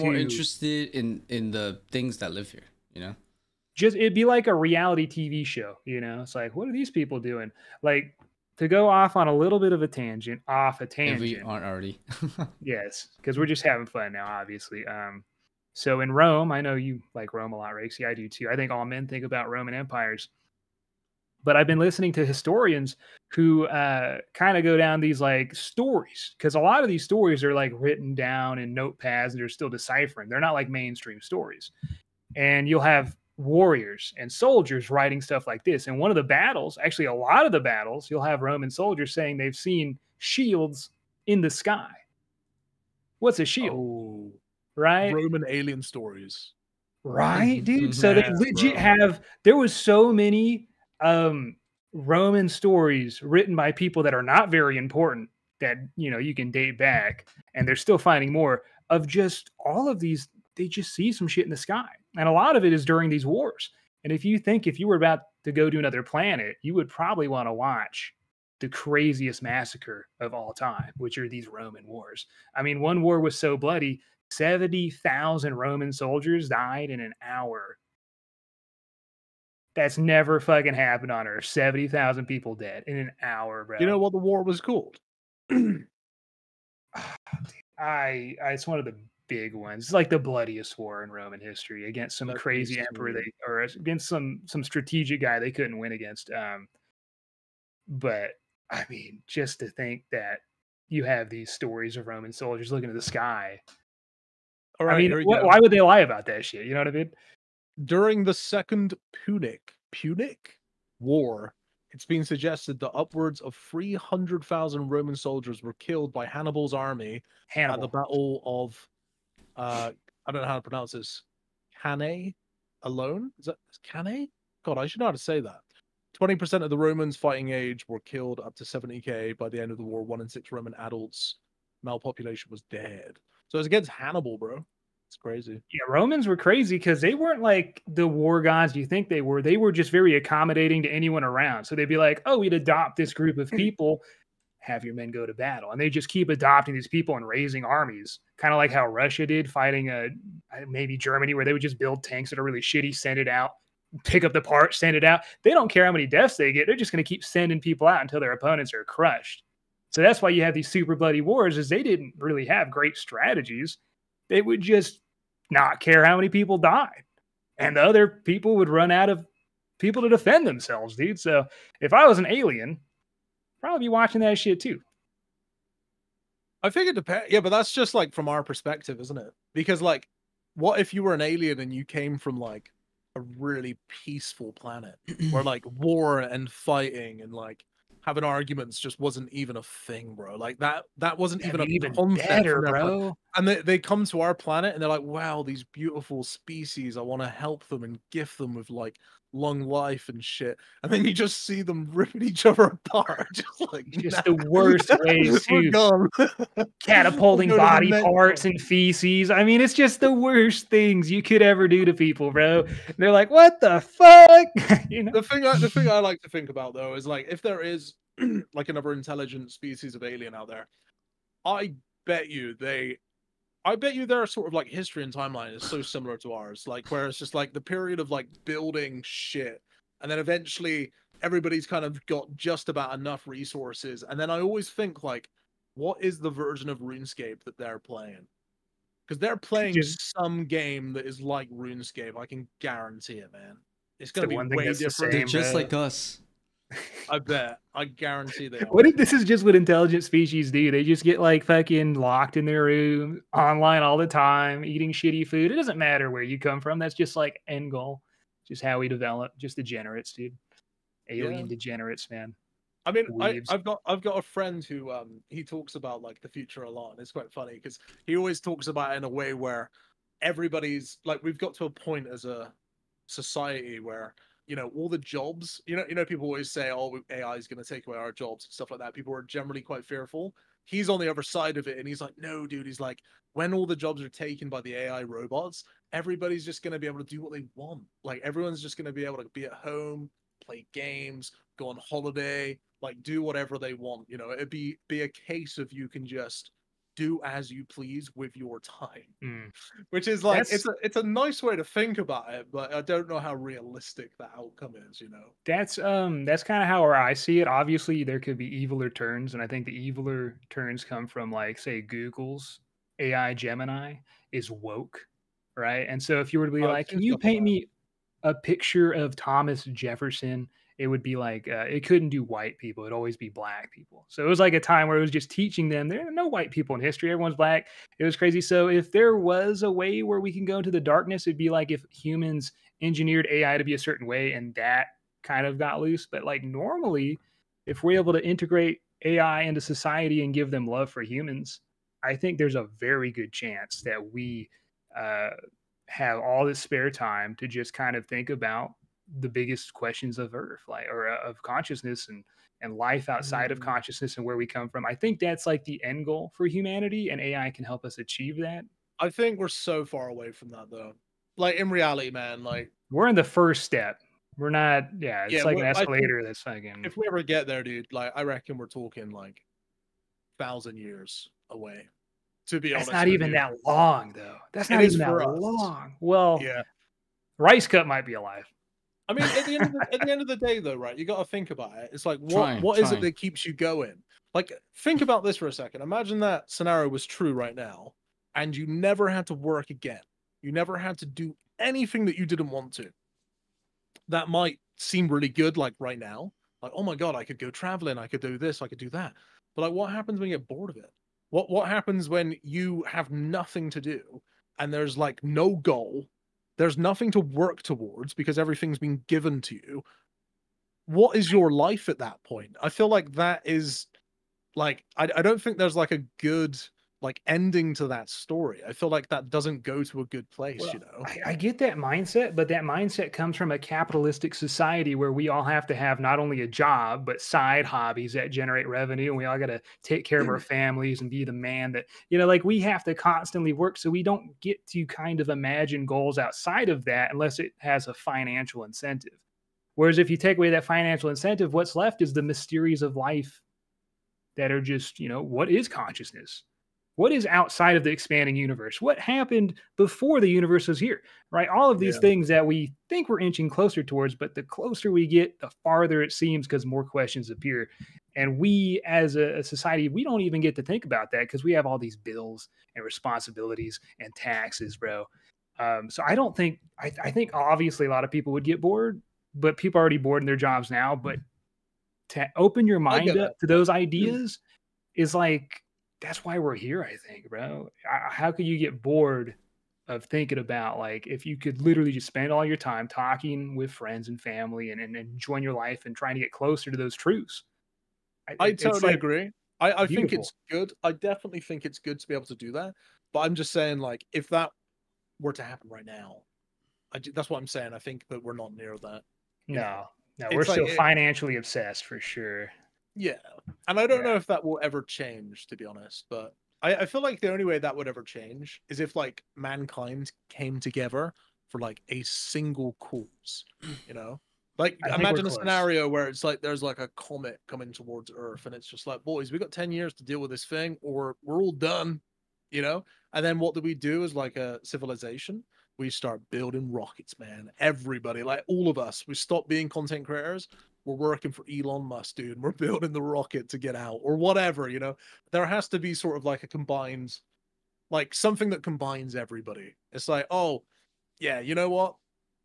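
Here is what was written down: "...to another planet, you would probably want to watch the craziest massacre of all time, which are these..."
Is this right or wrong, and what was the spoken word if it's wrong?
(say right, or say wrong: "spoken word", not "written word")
right.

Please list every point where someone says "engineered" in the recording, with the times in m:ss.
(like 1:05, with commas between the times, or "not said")
5:32.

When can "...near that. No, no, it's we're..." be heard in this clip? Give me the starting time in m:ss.
8:18.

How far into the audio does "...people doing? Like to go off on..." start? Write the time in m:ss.
0:06.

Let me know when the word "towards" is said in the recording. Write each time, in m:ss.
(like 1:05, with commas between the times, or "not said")
6:47, 7:33, 8:37.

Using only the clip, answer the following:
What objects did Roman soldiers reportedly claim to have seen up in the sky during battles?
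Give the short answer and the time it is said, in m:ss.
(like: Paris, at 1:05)
Shields, at 0:40.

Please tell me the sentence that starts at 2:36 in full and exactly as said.
They're just going to keep sending people out until their opponents are crushed.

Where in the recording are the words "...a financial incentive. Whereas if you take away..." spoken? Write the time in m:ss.
7:17.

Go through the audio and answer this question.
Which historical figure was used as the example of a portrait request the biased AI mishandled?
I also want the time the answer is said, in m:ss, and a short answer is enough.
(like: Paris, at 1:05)
Thomas Jefferson, at 5:19.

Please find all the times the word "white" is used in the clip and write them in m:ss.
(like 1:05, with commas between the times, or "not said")
5:22, 5:26.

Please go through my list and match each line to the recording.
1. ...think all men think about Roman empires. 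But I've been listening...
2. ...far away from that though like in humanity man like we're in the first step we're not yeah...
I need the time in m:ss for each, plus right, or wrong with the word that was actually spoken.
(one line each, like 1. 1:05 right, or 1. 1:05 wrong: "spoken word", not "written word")
1. 0:18 right
2. 5:59 wrong: "reality", not "humanity".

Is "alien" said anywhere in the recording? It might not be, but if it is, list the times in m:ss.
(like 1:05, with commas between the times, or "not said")
0:45, 2:52, 3:01, 3:40, 4:21.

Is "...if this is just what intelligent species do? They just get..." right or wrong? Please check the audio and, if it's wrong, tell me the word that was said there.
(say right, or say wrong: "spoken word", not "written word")
right.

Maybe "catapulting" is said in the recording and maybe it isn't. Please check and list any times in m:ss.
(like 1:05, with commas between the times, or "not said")
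3:26.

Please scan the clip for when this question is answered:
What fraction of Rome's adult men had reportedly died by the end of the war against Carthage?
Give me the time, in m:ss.
2:10.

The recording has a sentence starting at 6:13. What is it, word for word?
that long though that's it not even that us.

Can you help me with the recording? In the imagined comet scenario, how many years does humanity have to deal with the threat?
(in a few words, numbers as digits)
10.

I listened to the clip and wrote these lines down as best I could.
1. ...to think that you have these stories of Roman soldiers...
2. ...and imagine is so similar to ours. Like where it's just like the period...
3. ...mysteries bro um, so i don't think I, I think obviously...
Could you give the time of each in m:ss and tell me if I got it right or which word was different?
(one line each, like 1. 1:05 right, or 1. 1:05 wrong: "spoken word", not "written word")
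1. 1:39 right
2. 3:45 wrong: "timeline", not "imagine"
3. 7:44 wrong: "taxes", not "mysteries".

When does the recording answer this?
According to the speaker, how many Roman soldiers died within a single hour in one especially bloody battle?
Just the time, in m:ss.
1:14.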